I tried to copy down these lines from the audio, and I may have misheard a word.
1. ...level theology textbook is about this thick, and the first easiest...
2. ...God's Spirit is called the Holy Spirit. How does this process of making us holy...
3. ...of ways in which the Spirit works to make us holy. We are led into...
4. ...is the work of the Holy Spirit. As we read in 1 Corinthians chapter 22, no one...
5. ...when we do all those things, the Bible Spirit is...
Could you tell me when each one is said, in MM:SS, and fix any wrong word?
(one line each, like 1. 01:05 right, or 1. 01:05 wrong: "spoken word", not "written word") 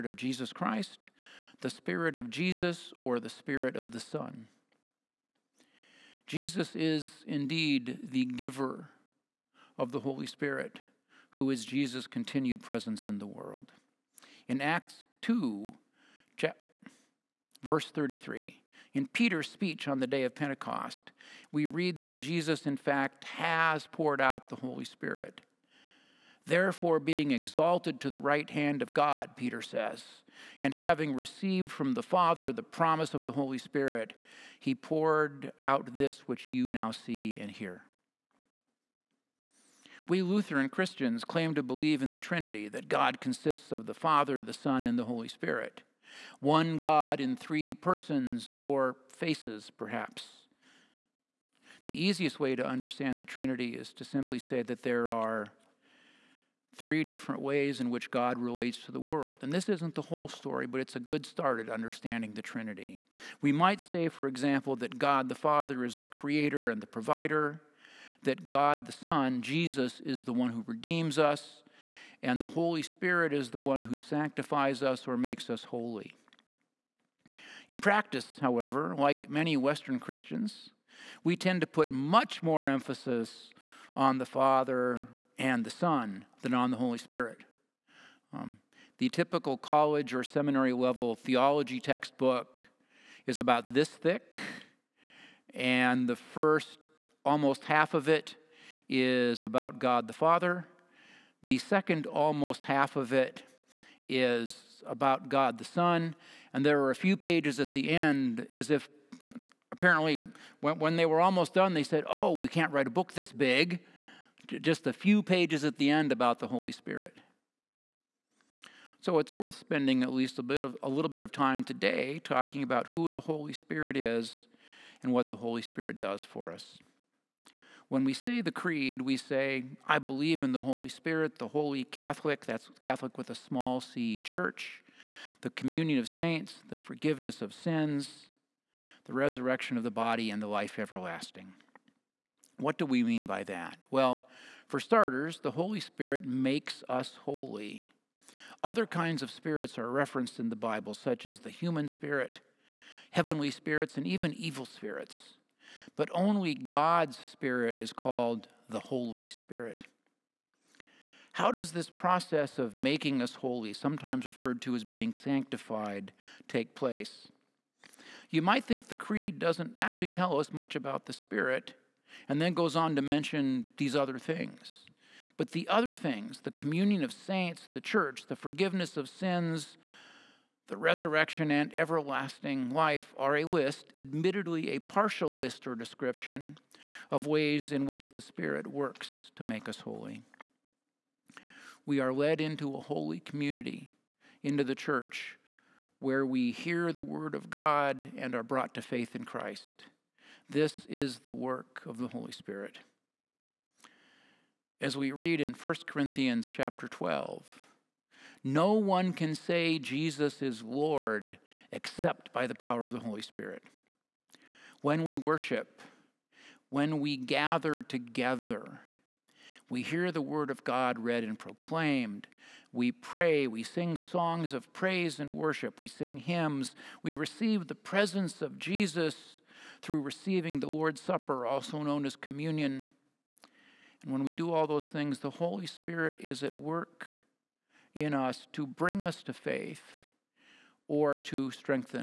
1. 01:30 wrong: "almost", not "easiest"
2. 02:36 right
3. 03:07 right
4. 03:20 wrong: "12", not "22"
5. 03:54 wrong: "Holy", not "Bible".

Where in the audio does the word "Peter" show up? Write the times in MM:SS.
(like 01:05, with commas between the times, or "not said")
00:19, 00:29.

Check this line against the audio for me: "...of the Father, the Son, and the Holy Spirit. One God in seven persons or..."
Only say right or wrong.
wrong.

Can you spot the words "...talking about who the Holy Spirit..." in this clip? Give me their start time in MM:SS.
02:02.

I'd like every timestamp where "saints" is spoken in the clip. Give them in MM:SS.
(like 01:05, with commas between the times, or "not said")
02:16, 02:57.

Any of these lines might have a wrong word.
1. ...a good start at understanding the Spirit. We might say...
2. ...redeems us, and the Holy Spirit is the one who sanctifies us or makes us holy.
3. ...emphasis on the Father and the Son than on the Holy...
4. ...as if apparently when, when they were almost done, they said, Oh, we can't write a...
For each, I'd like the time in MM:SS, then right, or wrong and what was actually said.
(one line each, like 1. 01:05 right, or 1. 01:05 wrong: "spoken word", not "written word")
1. 01:00 wrong: "Trinity", not "Spirit"
2. 01:10 right
3. 01:22 right
4. 01:48 right.